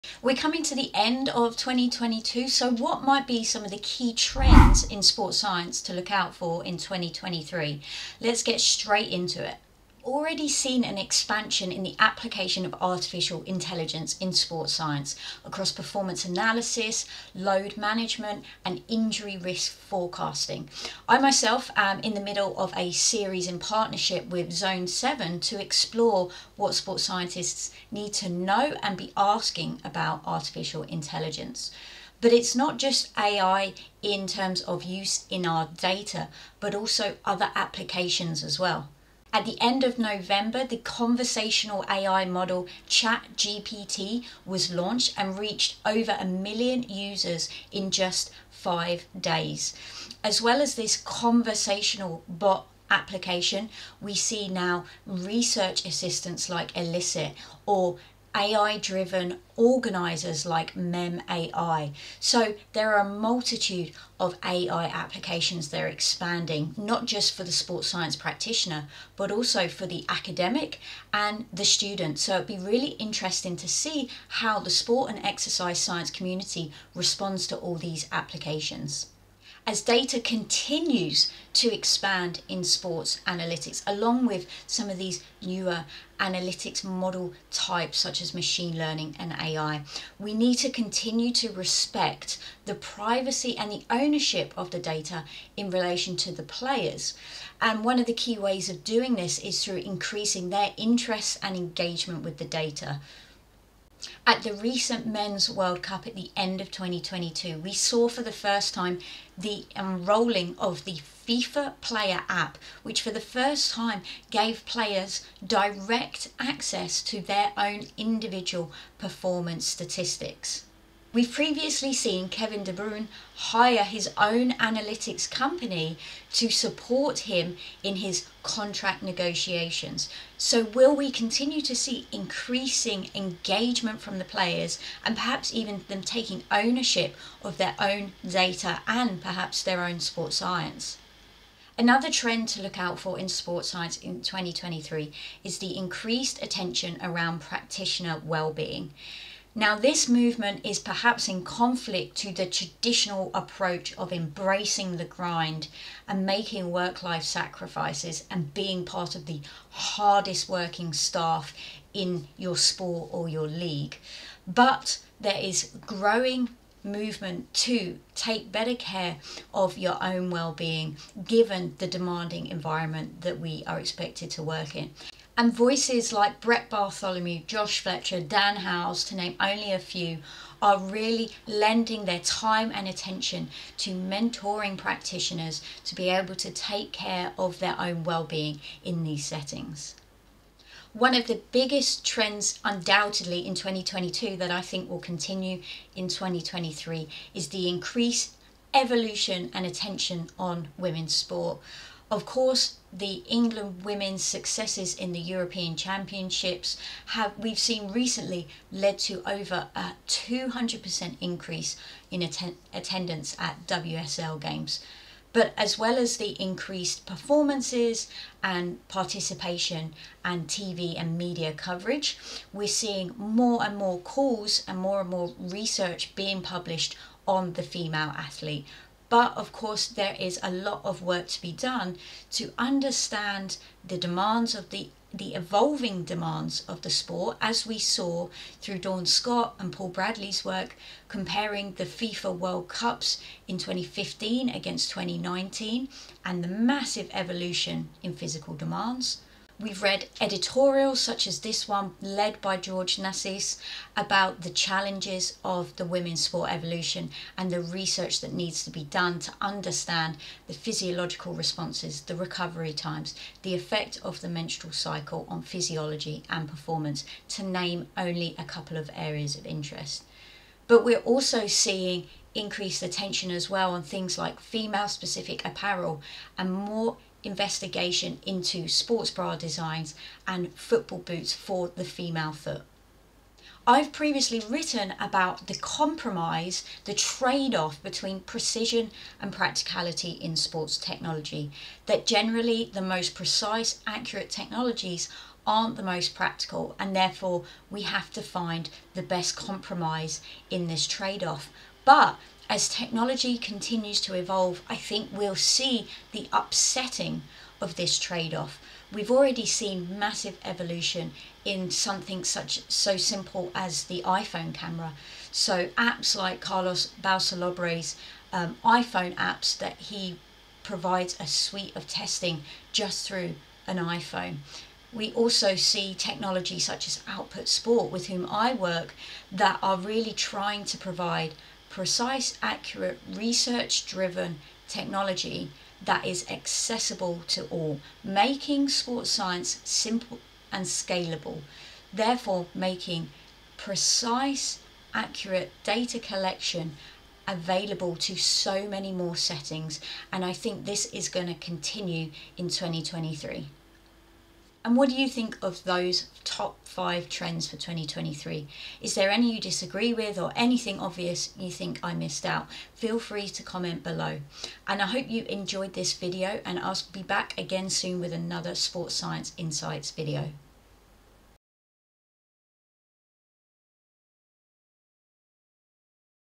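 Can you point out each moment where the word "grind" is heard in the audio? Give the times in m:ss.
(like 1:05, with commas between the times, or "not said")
2:35.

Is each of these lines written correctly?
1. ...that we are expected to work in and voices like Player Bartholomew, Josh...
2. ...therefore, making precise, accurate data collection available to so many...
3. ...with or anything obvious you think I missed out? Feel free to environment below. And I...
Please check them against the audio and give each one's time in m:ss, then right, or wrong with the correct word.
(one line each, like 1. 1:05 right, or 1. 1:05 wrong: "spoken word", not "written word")
1. 2:53 wrong: "Brett", not "Player"
2. 5:41 right
3. 5:59 wrong: "comment", not "environment".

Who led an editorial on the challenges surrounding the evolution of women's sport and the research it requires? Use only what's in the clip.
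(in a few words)
George Nassis.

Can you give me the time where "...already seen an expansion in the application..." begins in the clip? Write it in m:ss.
0:10.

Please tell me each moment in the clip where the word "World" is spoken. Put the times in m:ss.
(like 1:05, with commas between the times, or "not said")
1:45, 4:02.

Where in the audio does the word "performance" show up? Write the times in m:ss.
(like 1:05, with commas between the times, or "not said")
0:15, 1:58, 3:37, 4:26.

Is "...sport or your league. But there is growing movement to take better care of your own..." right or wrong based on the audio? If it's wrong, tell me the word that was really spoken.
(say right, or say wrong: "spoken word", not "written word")
right.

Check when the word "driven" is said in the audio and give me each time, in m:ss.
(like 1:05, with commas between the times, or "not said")
0:58, 5:33.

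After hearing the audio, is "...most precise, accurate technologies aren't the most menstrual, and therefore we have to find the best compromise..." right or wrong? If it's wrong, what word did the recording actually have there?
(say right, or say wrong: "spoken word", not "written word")
wrong: "practical", not "menstrual".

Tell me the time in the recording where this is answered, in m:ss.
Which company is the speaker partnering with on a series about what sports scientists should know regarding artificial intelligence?
0:24.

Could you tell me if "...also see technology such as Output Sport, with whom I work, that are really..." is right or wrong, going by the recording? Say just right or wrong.
right.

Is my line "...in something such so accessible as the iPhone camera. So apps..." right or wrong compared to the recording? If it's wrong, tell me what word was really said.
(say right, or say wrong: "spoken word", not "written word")
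wrong: "simple", not "accessible".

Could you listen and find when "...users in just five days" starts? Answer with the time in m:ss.
0:46.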